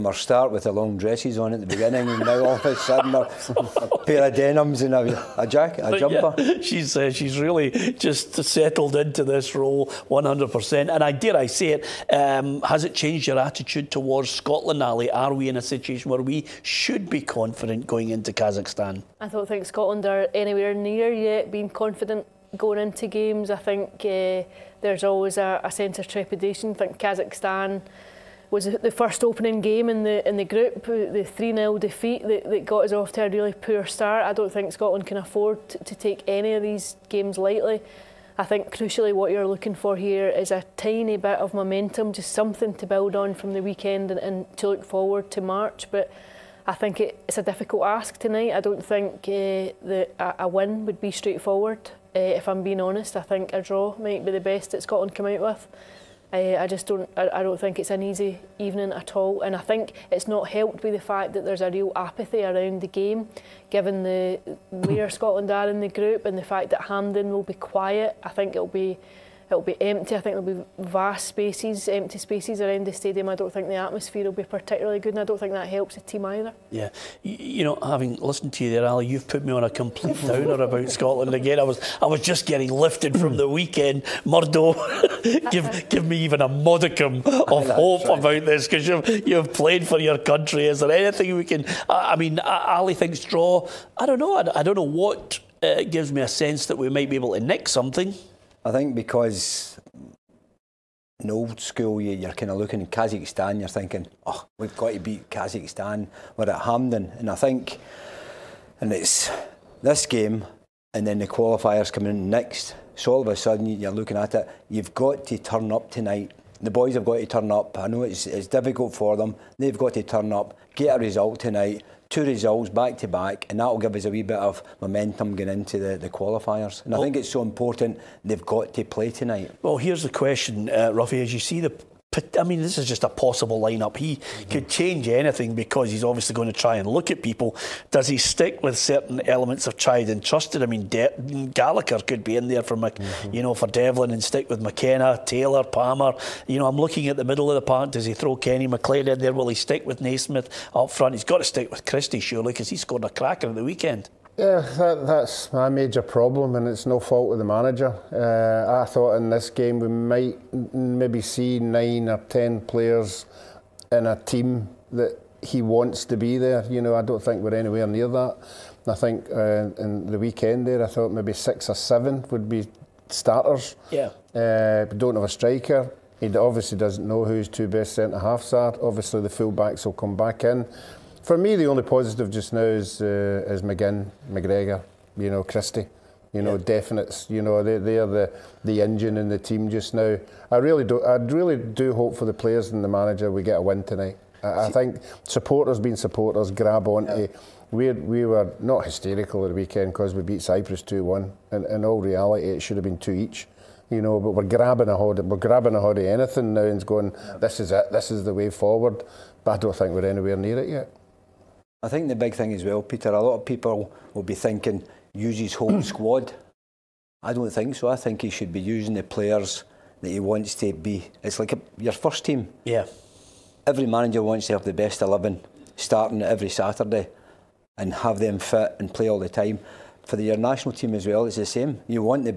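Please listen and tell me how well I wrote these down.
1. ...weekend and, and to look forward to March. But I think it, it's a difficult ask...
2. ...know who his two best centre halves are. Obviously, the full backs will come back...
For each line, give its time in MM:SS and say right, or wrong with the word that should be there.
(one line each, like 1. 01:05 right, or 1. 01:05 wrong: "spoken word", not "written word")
1. 00:43 right
2. 02:57 right.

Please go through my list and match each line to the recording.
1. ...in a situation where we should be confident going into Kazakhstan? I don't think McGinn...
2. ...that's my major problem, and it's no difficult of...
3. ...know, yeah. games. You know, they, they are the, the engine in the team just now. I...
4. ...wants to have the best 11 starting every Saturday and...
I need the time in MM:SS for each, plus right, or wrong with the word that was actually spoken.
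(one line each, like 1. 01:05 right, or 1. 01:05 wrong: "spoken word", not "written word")
1. 00:15 wrong: "Scotland", not "McGinn"
2. 02:35 wrong: "fault", not "difficult"
3. 03:06 wrong: "definites", not "games"
4. 03:44 right.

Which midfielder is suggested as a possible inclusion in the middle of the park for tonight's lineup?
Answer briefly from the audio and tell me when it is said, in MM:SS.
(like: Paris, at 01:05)
Kenny McLean, at 02:28.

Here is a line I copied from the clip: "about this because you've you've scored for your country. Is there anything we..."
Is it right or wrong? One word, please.
wrong.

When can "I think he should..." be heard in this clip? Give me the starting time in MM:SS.
03:37.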